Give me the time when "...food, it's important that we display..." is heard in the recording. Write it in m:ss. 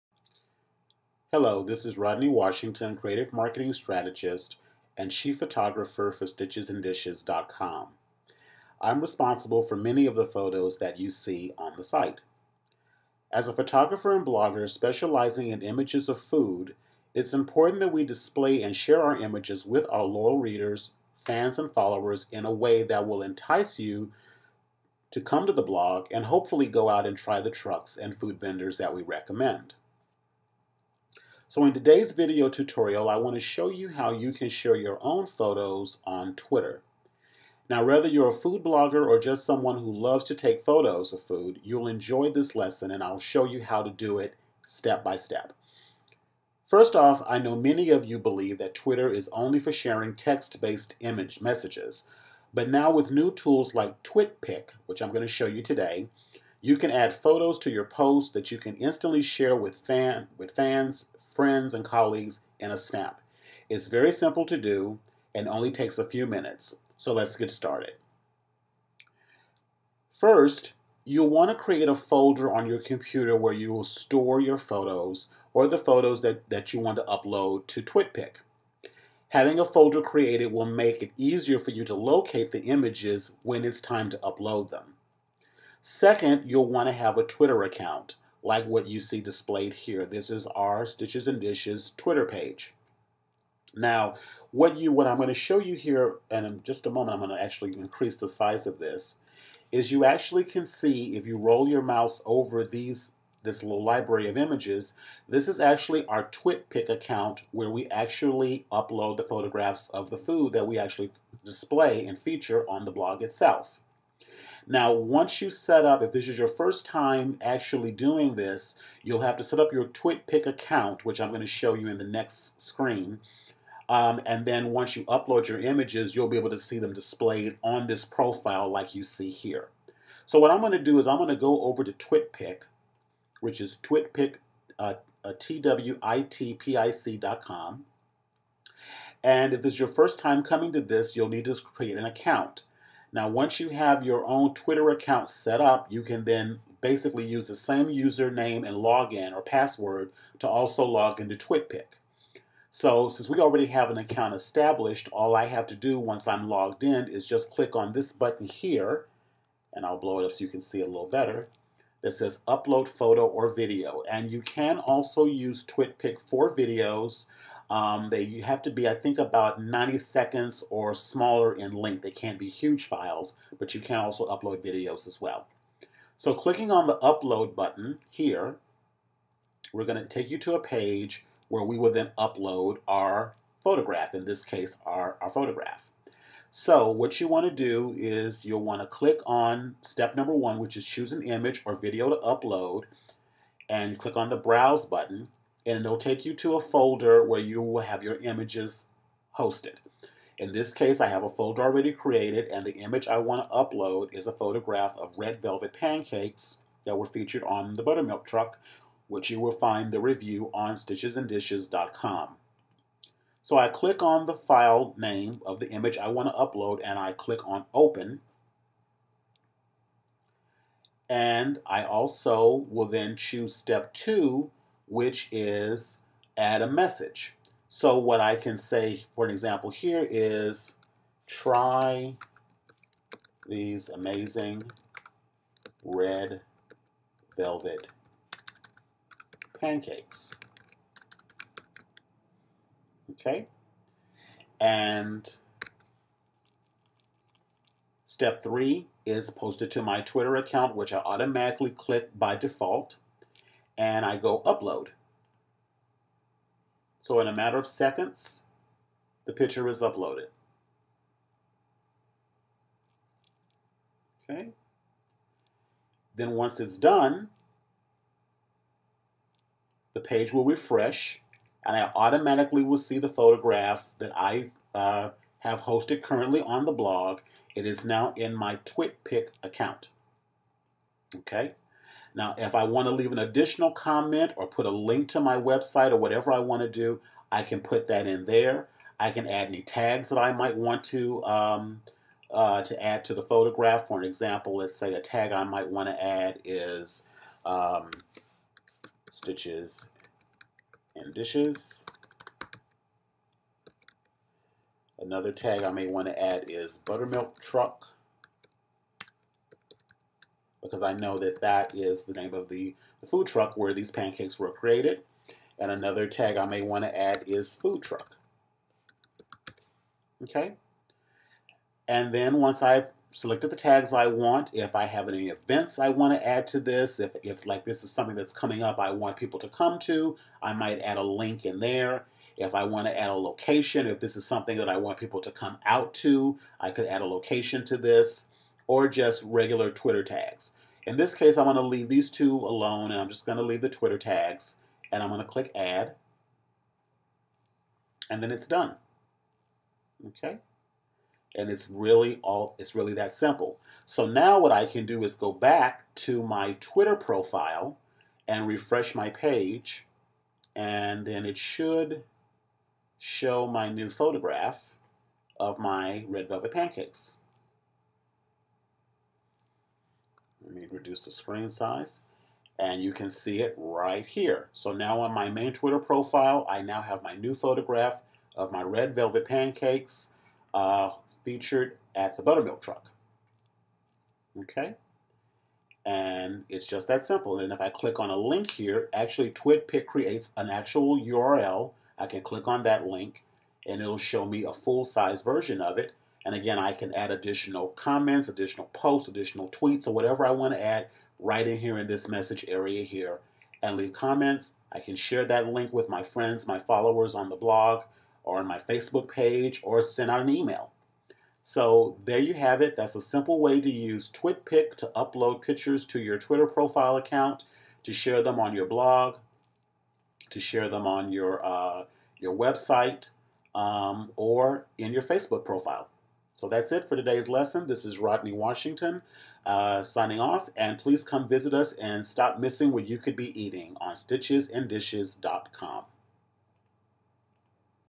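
0:16.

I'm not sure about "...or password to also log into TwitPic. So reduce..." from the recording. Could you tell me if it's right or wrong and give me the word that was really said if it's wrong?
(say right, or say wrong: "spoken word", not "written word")
wrong: "since", not "reduce".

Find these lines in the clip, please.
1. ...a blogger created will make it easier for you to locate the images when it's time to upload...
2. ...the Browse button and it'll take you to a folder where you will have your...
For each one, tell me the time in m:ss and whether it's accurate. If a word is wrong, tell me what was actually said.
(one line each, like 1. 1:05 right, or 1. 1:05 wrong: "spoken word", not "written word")
1. 1:19 wrong: "folder", not "blogger"
2. 3:14 right.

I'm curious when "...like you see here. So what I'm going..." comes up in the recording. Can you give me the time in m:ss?
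2:08.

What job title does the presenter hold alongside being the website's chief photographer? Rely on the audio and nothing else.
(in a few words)
Creative Marketing Strategist.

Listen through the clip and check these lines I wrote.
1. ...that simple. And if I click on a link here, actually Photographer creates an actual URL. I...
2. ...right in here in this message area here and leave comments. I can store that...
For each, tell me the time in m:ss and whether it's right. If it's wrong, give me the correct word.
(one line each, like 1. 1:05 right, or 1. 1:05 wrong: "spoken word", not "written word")
1. 6:26 wrong: "TwitPic", not "Photographer"
2. 6:41 wrong: "share", not "store".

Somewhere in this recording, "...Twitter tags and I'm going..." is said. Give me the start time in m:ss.
5:43.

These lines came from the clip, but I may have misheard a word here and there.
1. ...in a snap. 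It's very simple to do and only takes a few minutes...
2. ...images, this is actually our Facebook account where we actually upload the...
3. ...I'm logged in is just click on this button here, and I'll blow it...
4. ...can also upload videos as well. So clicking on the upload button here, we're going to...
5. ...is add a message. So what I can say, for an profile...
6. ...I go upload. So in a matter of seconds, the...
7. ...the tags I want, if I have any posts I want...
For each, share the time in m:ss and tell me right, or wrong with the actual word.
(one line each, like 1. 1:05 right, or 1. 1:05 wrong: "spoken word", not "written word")
1. 1:02 right
2. 1:44 wrong: "TwitPic", not "Facebook"
3. 2:36 right
4. 2:53 right
5. 3:45 wrong: "example", not "profile"
6. 4:14 right
7. 5:23 wrong: "events", not "posts".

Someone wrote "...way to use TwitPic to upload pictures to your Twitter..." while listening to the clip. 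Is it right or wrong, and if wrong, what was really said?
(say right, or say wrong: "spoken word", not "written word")
right.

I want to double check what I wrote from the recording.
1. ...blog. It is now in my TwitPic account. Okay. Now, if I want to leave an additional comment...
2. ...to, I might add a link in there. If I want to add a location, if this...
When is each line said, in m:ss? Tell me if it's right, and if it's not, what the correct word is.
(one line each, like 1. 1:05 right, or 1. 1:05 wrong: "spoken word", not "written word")
1. 4:36 right
2. 5:29 right.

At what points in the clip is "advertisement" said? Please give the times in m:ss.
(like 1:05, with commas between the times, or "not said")
not said.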